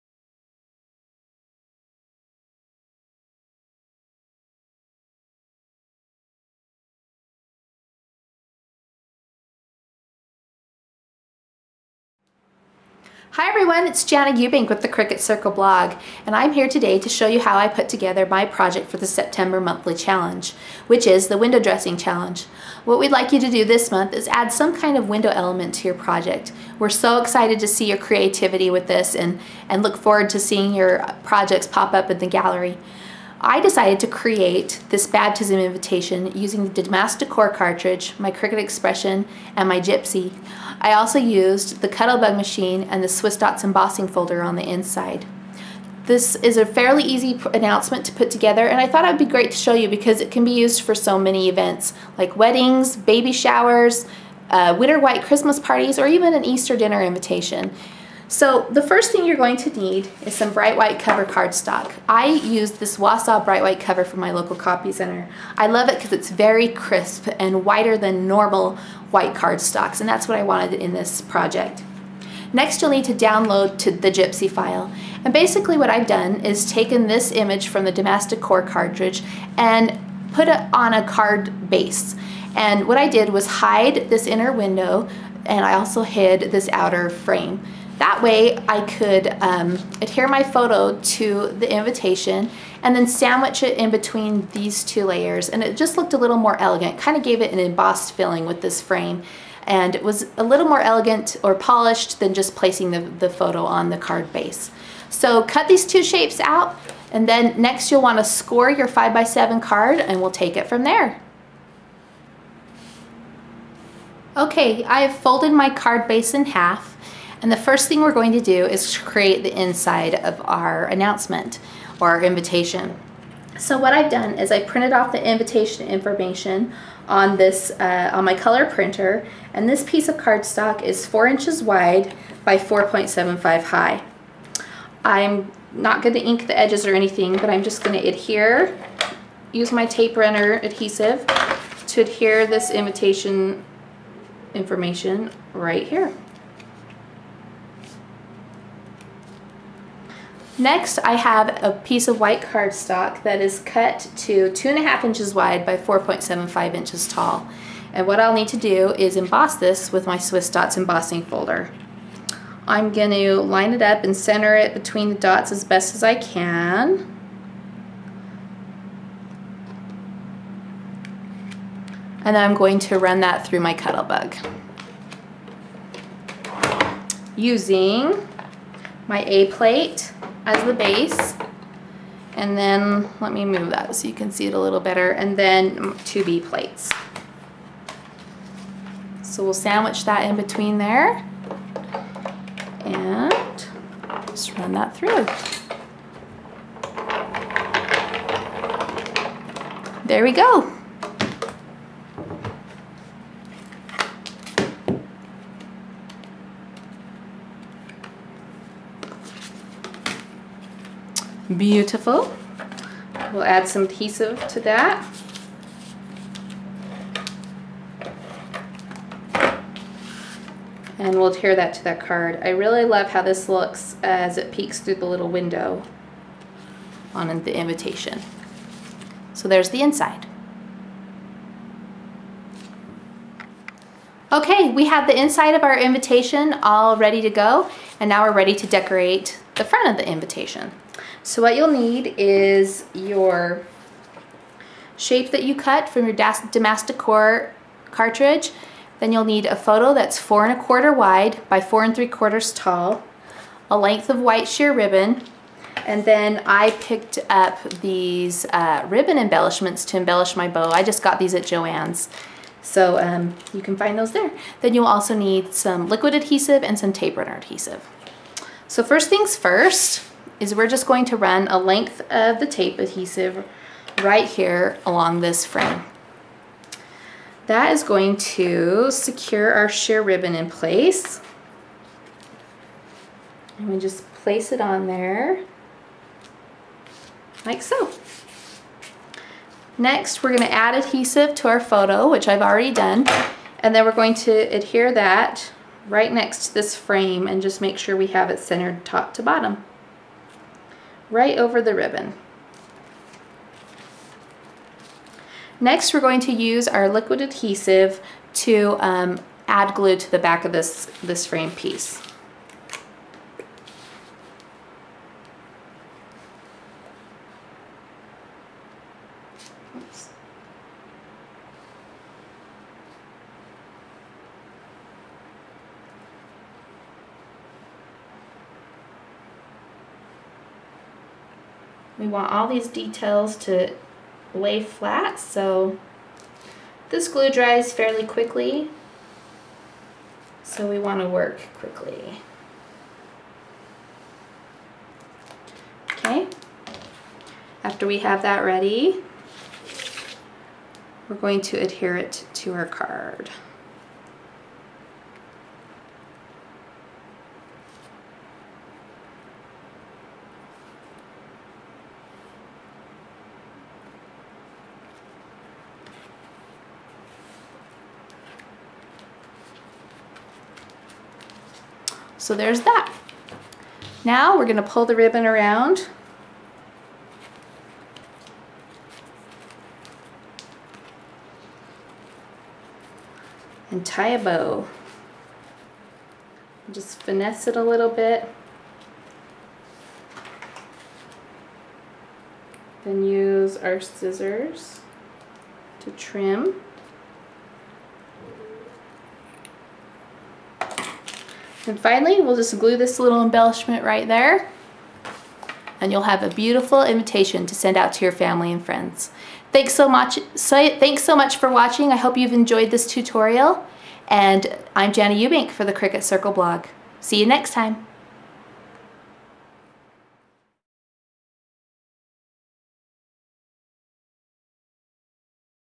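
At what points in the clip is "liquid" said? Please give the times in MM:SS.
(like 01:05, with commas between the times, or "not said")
04:25, 05:06.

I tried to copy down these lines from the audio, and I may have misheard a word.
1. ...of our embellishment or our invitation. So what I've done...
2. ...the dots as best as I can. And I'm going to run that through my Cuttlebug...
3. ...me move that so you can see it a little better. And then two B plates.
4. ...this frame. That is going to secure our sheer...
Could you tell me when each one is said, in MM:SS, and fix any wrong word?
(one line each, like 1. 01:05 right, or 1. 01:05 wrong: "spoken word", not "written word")
1. 02:00 wrong: "announcement", not "embellishment"
2. 02:45 right
3. 03:03 right
4. 04:35 right.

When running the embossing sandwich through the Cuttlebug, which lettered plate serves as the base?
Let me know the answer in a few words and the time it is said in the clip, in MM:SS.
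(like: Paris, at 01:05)
A plate, at 02:59.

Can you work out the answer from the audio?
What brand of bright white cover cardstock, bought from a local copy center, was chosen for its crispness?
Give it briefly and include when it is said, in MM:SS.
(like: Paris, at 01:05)
Wausau, at 01:02.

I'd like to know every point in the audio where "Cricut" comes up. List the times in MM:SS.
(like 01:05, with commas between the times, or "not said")
00:14, 00:38, 06:55.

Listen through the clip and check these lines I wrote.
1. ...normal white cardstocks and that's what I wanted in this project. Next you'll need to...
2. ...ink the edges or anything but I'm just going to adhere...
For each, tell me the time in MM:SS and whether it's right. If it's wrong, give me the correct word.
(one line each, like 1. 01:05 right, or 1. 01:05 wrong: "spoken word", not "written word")
1. 01:08 right
2. 02:16 right.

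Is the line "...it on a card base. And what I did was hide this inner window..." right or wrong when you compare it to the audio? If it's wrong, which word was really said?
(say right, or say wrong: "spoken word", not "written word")
right.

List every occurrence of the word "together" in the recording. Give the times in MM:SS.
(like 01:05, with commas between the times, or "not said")
00:17, 00:48.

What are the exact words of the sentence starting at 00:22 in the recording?
What we'd like you to do this month is add some kind of window element to your project.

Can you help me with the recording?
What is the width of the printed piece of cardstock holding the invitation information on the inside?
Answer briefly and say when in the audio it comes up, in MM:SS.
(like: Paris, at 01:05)
4 inches, at 02:11.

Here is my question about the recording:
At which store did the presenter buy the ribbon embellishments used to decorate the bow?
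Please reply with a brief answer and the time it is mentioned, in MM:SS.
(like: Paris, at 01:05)
Joann's, at 04:21.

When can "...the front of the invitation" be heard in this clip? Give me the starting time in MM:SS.
03:59.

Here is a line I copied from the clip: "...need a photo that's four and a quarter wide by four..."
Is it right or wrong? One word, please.
right.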